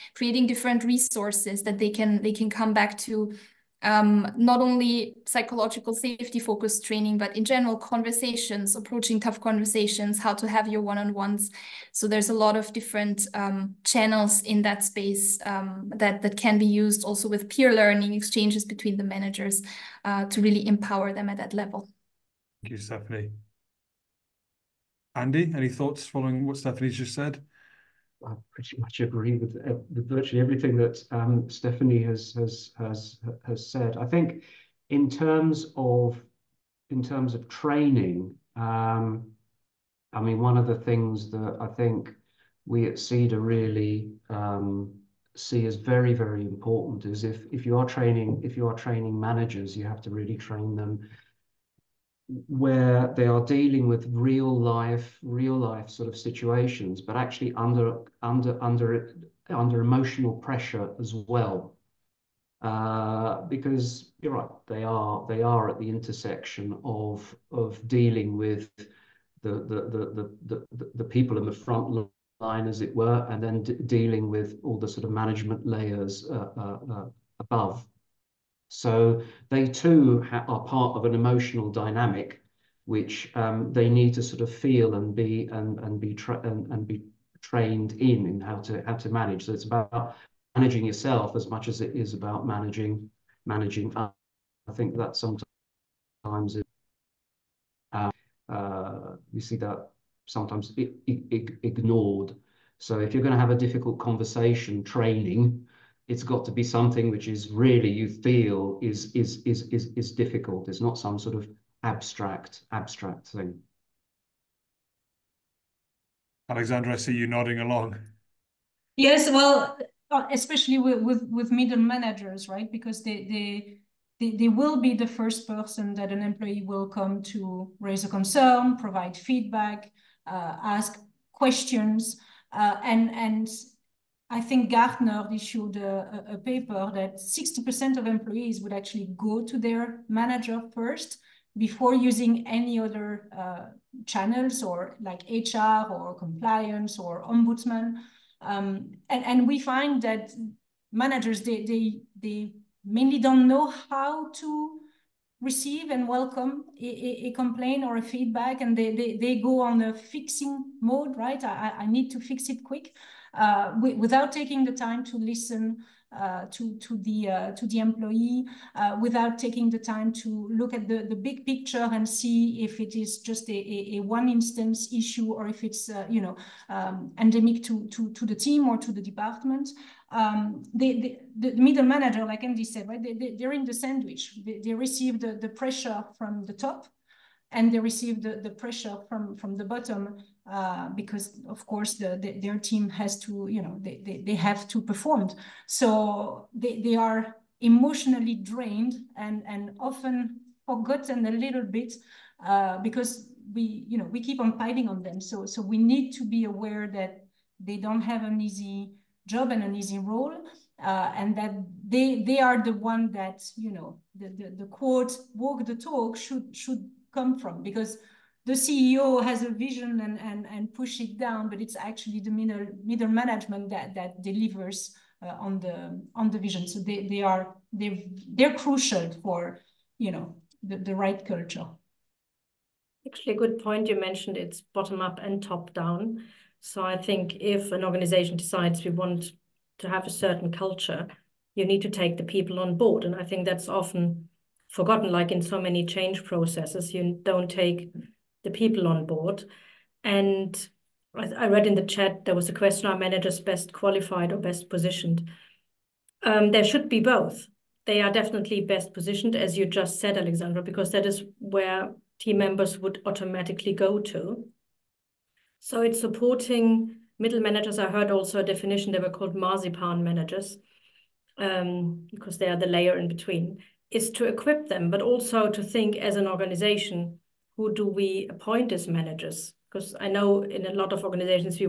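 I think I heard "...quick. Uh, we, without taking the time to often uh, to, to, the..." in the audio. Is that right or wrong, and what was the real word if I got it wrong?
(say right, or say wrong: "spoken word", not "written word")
wrong: "listen", not "often".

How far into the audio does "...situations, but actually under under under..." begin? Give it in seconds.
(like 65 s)
56 s.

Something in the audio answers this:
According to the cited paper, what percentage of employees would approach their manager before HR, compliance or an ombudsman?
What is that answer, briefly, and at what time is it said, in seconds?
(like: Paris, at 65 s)
60%, at 137 s.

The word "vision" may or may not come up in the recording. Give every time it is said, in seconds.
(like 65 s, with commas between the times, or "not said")
219 s, 226 s.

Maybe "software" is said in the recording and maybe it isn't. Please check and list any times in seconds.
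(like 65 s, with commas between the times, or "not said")
not said.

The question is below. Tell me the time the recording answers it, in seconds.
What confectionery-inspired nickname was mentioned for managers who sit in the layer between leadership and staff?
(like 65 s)
269 s.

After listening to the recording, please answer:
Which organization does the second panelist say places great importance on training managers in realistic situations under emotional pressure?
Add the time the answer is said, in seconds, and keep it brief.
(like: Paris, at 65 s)
CEDR, at 42 s.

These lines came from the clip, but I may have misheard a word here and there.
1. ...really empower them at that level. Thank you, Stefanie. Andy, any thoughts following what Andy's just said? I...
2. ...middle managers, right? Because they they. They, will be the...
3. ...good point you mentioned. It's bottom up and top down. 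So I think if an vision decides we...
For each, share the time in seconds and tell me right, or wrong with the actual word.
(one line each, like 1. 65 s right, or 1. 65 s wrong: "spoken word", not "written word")
1. 20 s wrong: "Stefanie", not "Andy"
2. 121 s right
3. 233 s wrong: "organization", not "vision".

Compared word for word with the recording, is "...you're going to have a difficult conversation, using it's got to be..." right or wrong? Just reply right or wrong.
wrong.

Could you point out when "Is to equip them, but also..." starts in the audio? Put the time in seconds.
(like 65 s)
273 s.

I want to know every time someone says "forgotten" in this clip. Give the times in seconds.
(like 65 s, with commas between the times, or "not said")
200 s, 244 s.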